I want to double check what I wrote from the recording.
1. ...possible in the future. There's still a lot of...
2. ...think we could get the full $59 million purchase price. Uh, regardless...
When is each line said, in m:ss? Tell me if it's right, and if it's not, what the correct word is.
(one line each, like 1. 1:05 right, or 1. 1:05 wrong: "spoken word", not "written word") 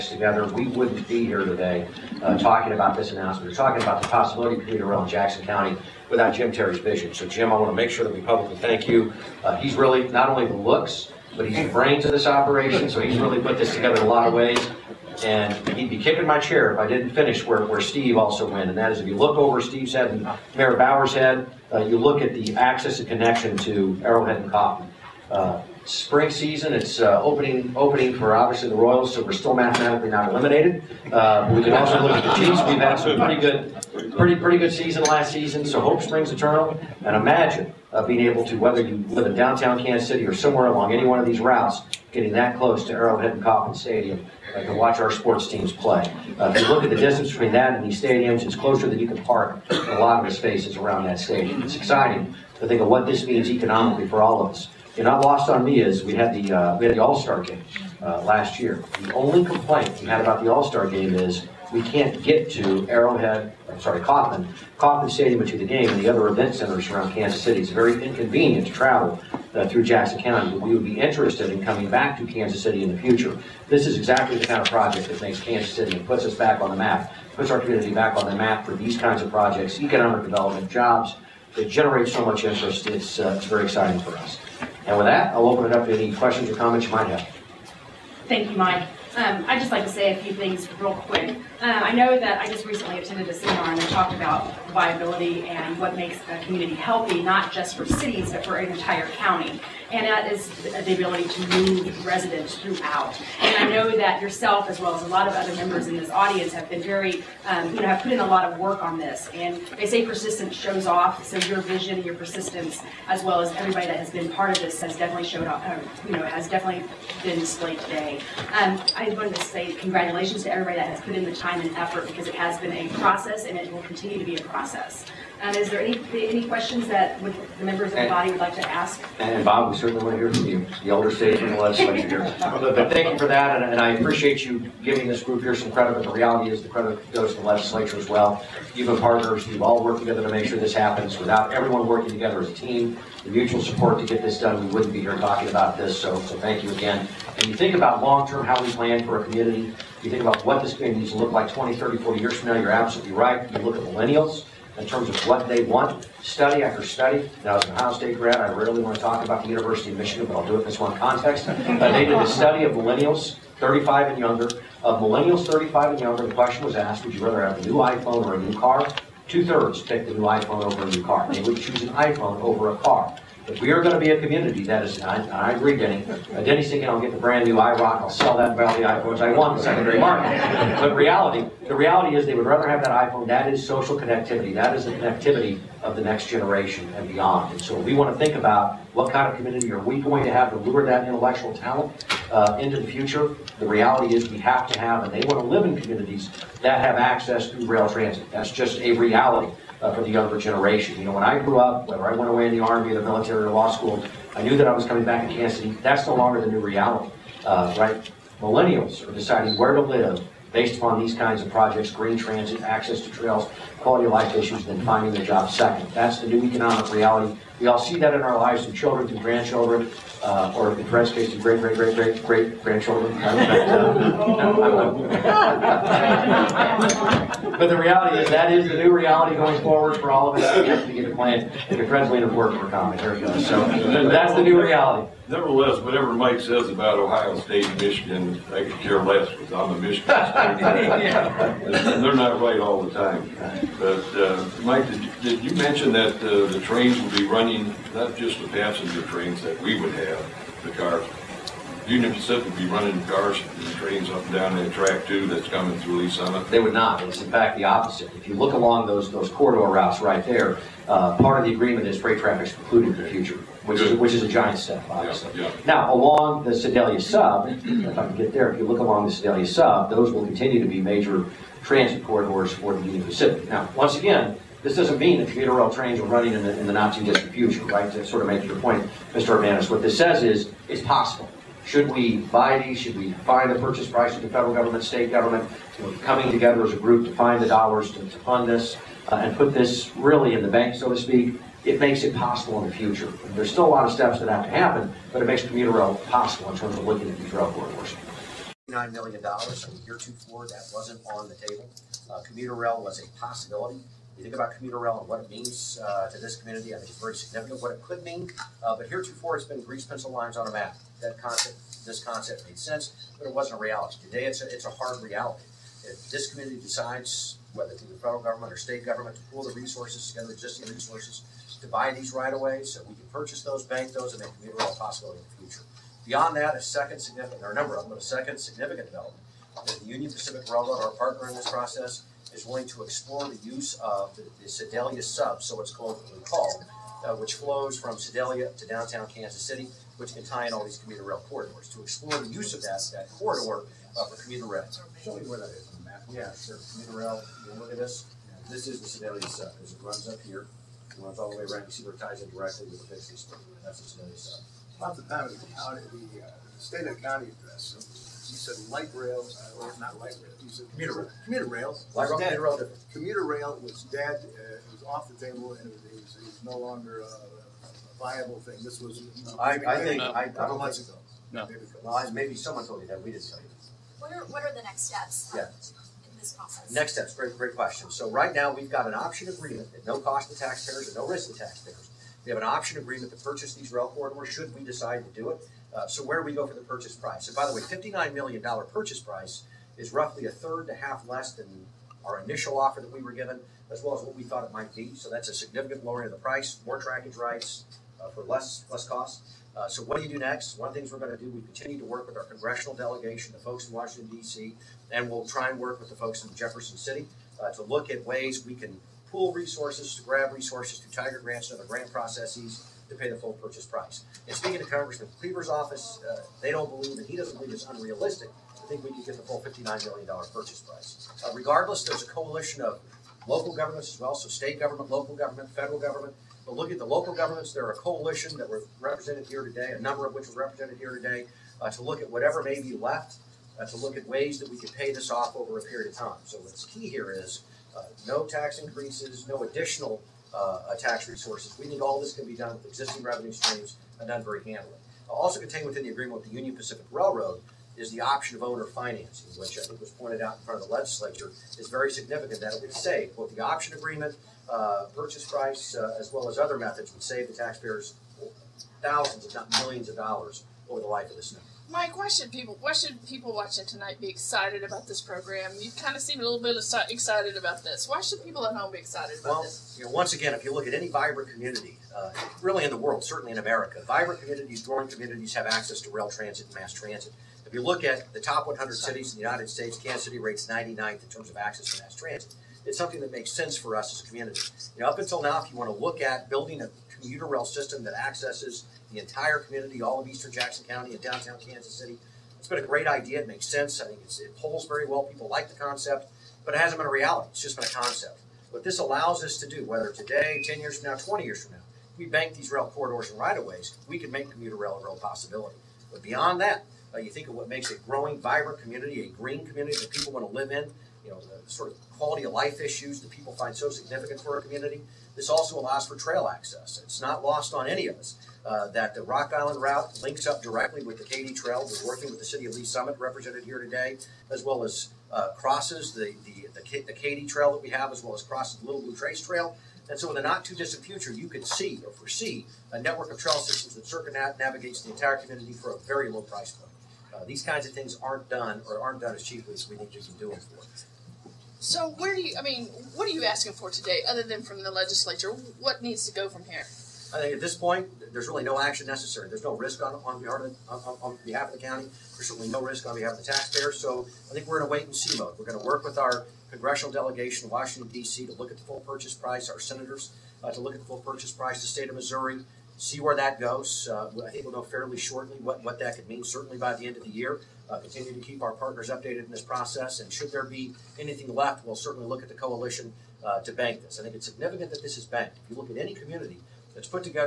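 1. 4:52 right
2. 6:58 right.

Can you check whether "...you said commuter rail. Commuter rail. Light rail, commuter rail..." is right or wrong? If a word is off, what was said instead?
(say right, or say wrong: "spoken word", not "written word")
right.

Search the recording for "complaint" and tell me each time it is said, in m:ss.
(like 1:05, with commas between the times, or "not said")
0:59.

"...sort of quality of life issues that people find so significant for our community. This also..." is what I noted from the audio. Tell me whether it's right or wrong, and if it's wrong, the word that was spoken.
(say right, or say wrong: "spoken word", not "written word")
right.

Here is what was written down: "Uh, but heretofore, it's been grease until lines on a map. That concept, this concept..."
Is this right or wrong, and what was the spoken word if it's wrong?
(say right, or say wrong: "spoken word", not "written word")
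wrong: "pencil", not "until".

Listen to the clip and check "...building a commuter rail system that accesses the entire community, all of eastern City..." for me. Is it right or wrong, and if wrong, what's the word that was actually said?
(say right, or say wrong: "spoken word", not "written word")
wrong: "Jackson", not "City".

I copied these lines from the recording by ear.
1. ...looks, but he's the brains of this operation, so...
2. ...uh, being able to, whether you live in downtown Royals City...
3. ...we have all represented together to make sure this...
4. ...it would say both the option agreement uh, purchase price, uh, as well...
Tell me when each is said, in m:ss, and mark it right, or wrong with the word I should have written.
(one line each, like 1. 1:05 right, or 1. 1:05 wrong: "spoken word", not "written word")
1. 0:10 right
2. 0:37 wrong: "Kansas", not "Royals"
3. 2:19 wrong: "worked", not "represented"
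4. 7:32 right.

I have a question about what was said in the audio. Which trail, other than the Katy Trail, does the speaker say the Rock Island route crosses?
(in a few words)
Little Blue Trace Trail.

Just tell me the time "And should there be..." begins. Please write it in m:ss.
9:30.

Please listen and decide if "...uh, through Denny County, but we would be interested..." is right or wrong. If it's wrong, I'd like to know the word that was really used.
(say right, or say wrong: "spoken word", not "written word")
wrong: "Jackson", not "Denny".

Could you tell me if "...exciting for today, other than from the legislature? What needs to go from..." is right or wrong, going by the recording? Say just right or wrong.
wrong.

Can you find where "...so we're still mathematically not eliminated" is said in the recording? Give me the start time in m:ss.
0:29.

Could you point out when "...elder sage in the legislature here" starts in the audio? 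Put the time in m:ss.
2:10.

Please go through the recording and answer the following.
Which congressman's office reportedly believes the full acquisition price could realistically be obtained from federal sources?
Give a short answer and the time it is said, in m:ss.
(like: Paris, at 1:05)
Congressman Cleaver, at 6:54.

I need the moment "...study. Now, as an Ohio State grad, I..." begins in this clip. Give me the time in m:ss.
2:36.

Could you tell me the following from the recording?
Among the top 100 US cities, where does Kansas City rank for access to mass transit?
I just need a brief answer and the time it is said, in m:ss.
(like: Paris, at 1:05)
99th, at 8:00.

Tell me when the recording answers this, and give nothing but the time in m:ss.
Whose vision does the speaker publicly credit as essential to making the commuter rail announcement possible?
0:06.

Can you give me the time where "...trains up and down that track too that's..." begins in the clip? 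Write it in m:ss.
4:13.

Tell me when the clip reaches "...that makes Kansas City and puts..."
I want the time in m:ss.
1:15.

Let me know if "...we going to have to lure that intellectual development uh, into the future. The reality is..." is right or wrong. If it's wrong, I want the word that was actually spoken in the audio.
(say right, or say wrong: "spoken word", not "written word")
wrong: "talent", not "development".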